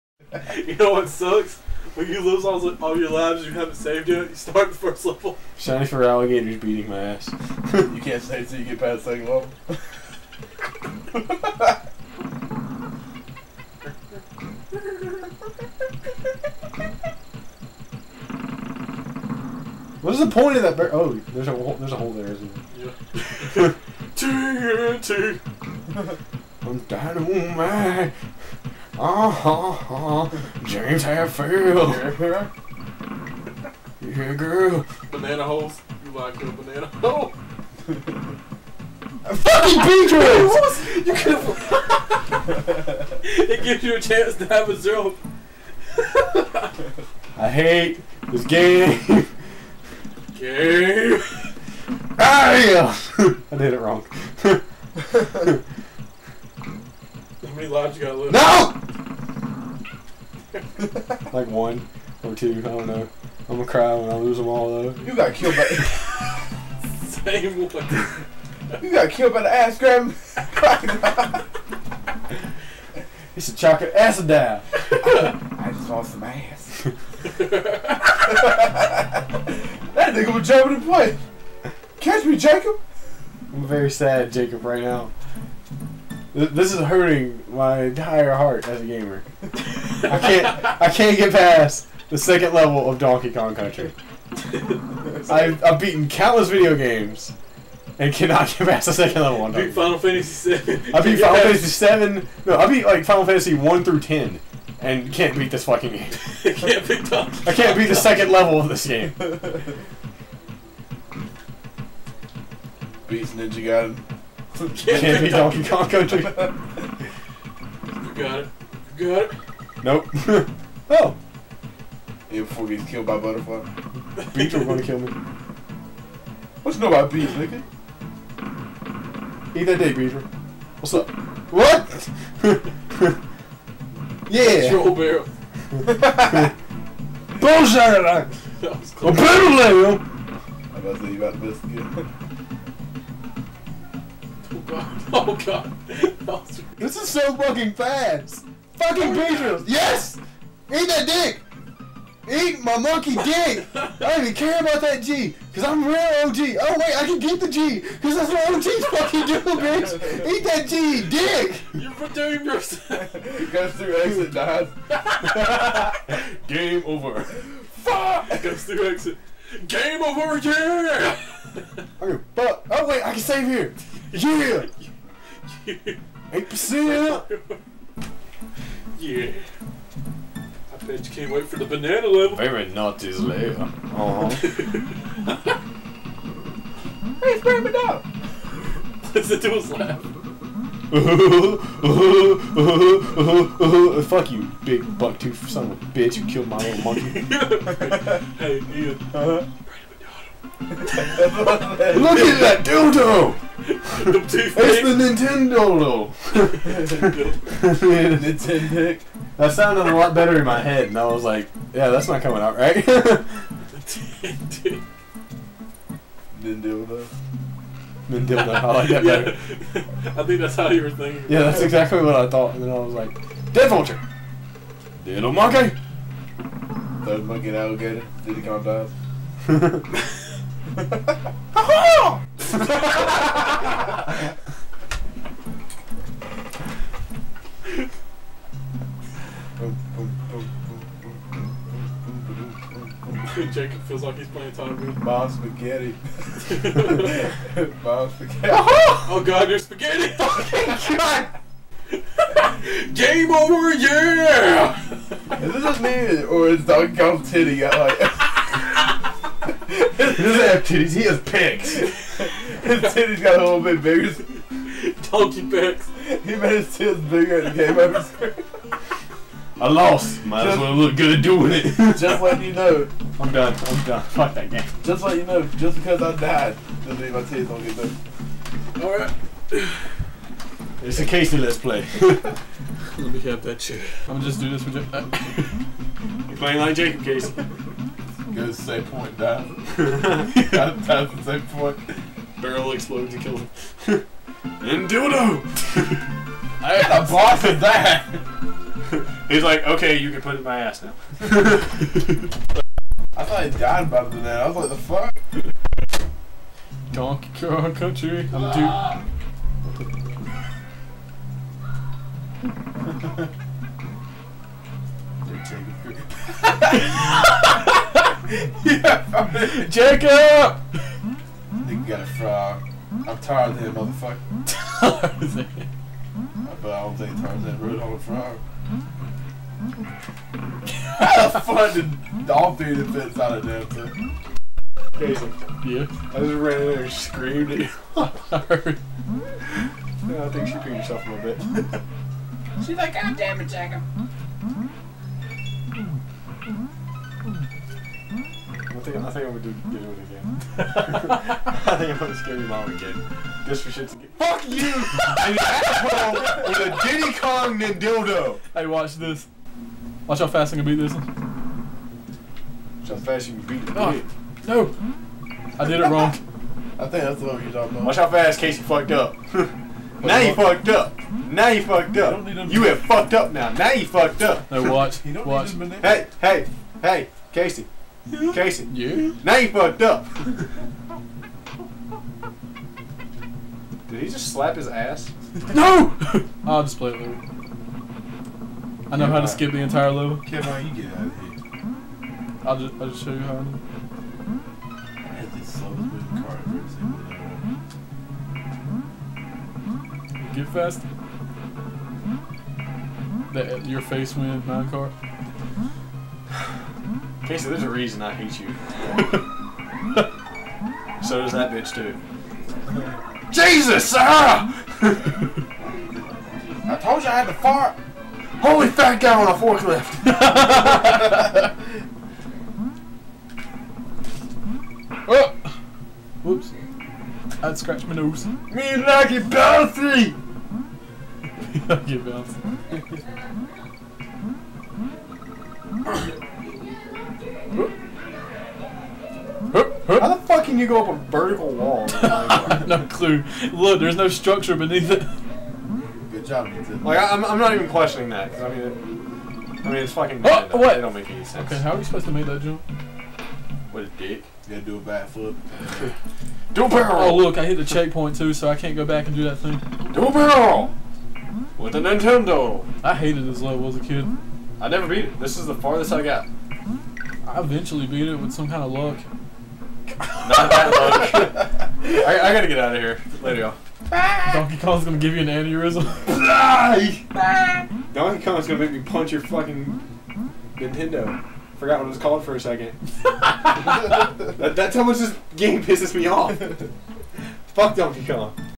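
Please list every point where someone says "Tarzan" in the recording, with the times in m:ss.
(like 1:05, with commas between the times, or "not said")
5:23, 5:27.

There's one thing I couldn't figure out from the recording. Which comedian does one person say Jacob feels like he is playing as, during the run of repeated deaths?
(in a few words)
Tom Green.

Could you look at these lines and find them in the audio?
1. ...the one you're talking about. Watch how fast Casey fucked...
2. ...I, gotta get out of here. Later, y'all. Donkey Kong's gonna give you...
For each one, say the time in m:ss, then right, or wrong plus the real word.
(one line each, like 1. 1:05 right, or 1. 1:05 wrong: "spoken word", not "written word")
1. 6:07 right
2. 7:52 right.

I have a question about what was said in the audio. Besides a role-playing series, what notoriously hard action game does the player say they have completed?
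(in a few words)
Ninja Gaiden.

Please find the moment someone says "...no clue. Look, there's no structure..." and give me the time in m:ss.
7:22.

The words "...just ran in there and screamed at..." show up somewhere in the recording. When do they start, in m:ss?
5:36.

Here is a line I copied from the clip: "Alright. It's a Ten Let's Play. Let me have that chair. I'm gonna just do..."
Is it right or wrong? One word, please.
wrong.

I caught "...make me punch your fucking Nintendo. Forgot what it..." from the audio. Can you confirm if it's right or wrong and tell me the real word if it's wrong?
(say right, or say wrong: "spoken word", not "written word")
right.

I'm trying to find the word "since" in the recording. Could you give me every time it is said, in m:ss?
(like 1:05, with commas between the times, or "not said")
not said.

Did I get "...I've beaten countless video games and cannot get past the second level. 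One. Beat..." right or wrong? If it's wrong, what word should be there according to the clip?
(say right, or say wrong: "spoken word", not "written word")
right.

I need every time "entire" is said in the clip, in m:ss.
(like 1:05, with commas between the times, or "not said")
1:27, 6:29.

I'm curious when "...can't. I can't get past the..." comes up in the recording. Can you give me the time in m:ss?
1:30.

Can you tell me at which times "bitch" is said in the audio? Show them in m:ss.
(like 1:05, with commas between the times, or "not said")
2:39, 3:15, 6:51.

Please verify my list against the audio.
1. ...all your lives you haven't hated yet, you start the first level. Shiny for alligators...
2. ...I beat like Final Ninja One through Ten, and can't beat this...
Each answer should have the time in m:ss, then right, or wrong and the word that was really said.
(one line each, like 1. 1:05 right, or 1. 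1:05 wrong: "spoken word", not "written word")
1. 0:02 wrong: "saved", not "hated"
2. 1:42 wrong: "Fantasy", not "Ninja".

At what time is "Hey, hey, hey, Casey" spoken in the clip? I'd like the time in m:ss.
6:15.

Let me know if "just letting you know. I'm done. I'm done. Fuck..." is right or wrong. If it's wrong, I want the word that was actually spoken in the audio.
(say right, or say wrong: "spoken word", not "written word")
right.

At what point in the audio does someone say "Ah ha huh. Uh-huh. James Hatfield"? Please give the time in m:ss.
0:29.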